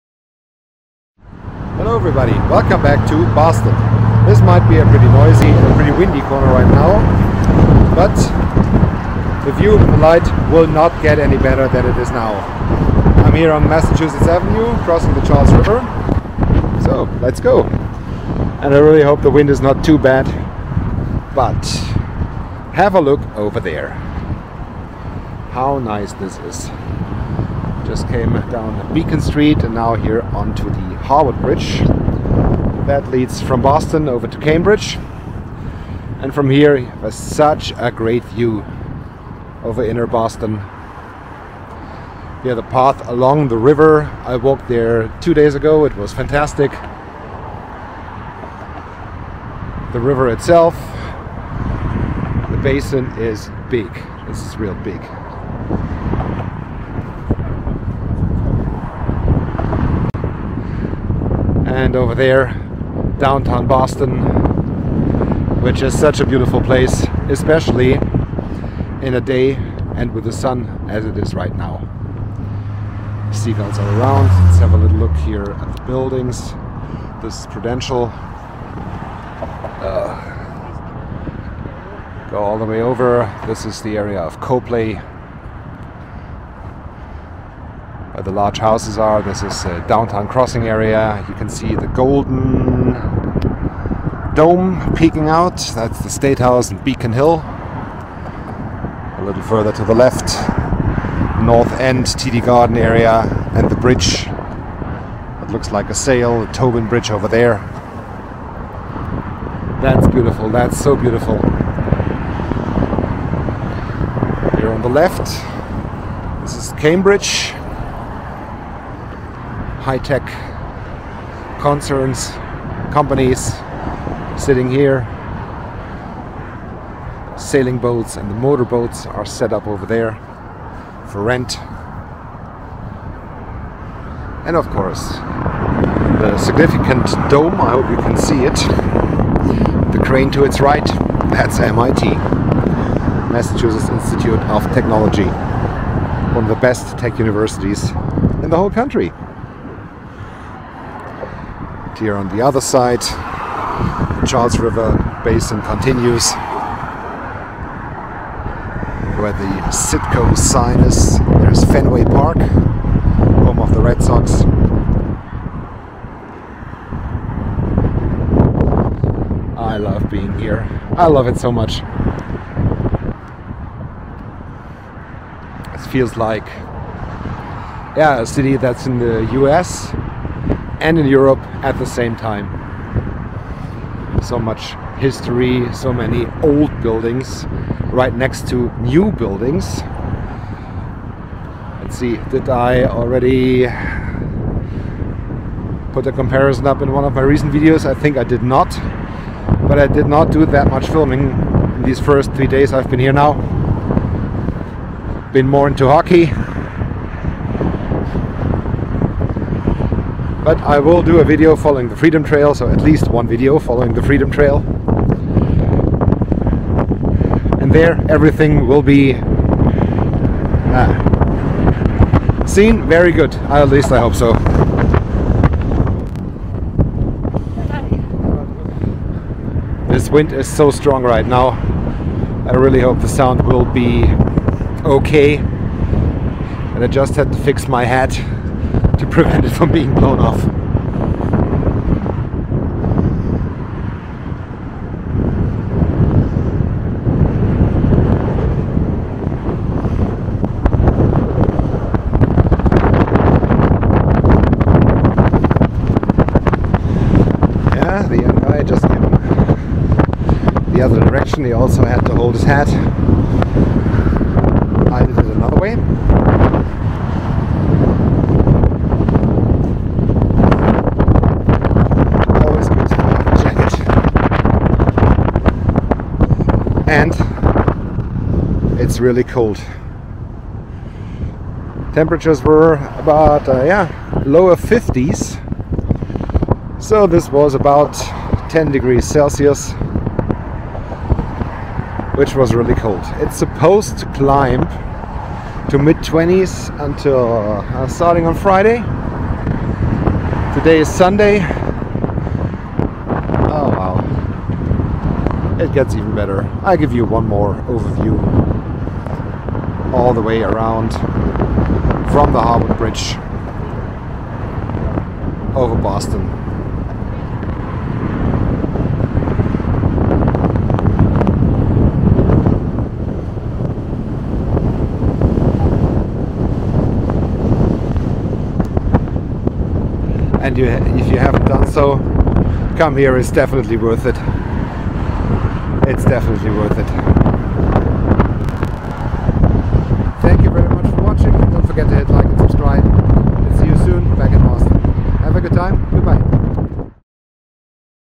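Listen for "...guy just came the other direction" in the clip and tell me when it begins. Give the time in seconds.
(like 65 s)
258 s.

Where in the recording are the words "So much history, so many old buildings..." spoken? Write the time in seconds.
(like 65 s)
184 s.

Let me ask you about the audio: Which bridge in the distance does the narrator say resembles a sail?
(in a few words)
Tobin Bridge.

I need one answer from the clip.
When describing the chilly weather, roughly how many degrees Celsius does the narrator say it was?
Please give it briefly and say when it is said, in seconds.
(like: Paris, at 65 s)
10, at 288 s.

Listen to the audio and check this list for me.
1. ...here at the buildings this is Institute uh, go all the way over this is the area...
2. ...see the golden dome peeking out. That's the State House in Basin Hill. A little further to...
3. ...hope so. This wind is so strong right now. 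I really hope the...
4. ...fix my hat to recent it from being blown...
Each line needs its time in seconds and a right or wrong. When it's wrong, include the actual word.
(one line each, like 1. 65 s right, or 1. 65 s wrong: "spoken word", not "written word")
1. 75 s wrong: "Prudential", not "Institute"
2. 91 s wrong: "Beacon", not "Basin"
3. 223 s right
4. 237 s wrong: "prevent", not "recent".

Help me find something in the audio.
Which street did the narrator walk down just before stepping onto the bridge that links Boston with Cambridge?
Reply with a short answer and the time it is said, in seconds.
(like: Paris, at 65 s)
Beacon Street, at 28 s.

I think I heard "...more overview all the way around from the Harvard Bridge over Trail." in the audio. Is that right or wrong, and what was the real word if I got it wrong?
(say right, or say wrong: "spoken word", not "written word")
wrong: "Boston", not "Trail".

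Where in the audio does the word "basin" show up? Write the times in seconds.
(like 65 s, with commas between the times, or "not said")
52 s, 155 s.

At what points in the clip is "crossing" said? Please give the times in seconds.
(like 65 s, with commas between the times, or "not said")
14 s, 90 s.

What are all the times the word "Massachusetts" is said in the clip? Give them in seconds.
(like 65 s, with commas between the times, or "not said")
13 s, 143 s.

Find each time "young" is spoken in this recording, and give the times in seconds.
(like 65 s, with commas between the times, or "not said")
258 s.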